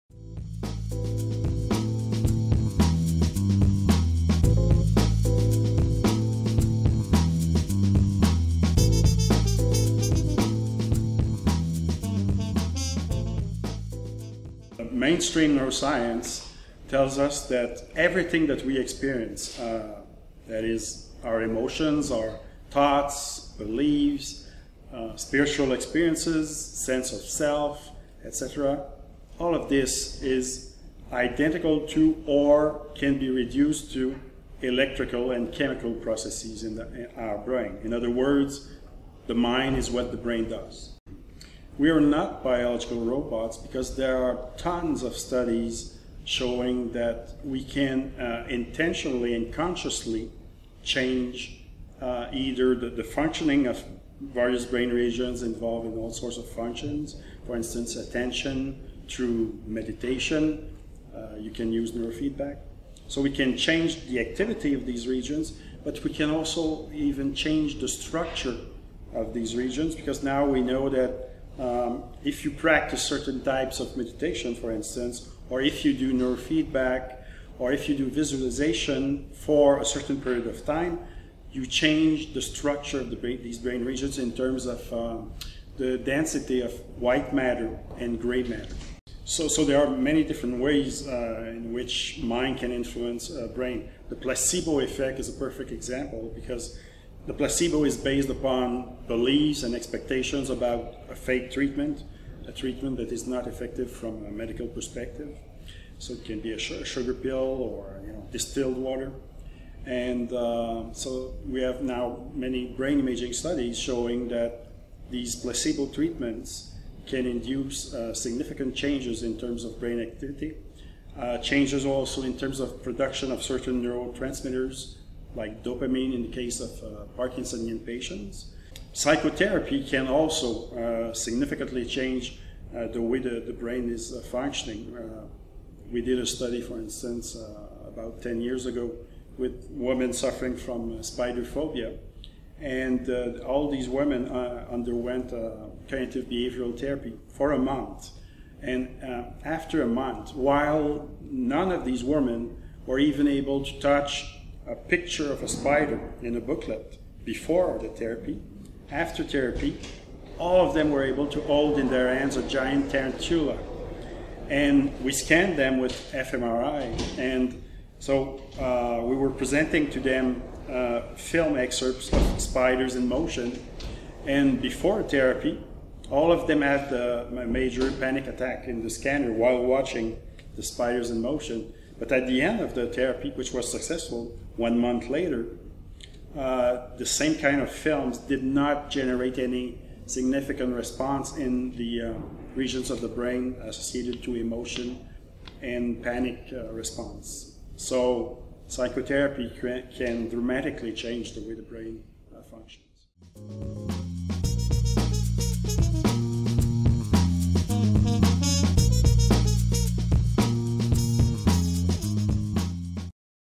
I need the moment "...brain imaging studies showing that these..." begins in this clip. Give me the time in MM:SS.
01:52.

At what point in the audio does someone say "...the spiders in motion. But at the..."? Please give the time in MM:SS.
03:00.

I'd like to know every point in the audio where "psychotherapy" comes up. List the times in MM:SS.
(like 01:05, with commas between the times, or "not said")
02:08, 03:18.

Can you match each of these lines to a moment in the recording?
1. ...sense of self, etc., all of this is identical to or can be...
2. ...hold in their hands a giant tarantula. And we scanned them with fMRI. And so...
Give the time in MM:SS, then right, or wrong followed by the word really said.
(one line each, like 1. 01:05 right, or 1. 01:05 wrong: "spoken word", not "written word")
1. 00:26 right
2. 02:41 right.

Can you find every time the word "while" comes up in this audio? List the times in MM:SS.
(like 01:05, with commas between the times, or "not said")
02:30, 02:59.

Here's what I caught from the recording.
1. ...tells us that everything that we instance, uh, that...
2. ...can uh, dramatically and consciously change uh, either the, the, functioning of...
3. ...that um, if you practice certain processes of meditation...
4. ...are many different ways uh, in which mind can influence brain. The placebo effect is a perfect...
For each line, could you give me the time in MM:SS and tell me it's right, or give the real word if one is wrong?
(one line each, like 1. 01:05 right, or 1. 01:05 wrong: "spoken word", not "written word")
1. 00:16 wrong: "experience", not "instance"
2. 00:47 wrong: "intentionally", not "dramatically"
3. 01:10 wrong: "types", not "processes"
4. 01:29 right.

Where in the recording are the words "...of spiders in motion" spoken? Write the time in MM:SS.
02:52.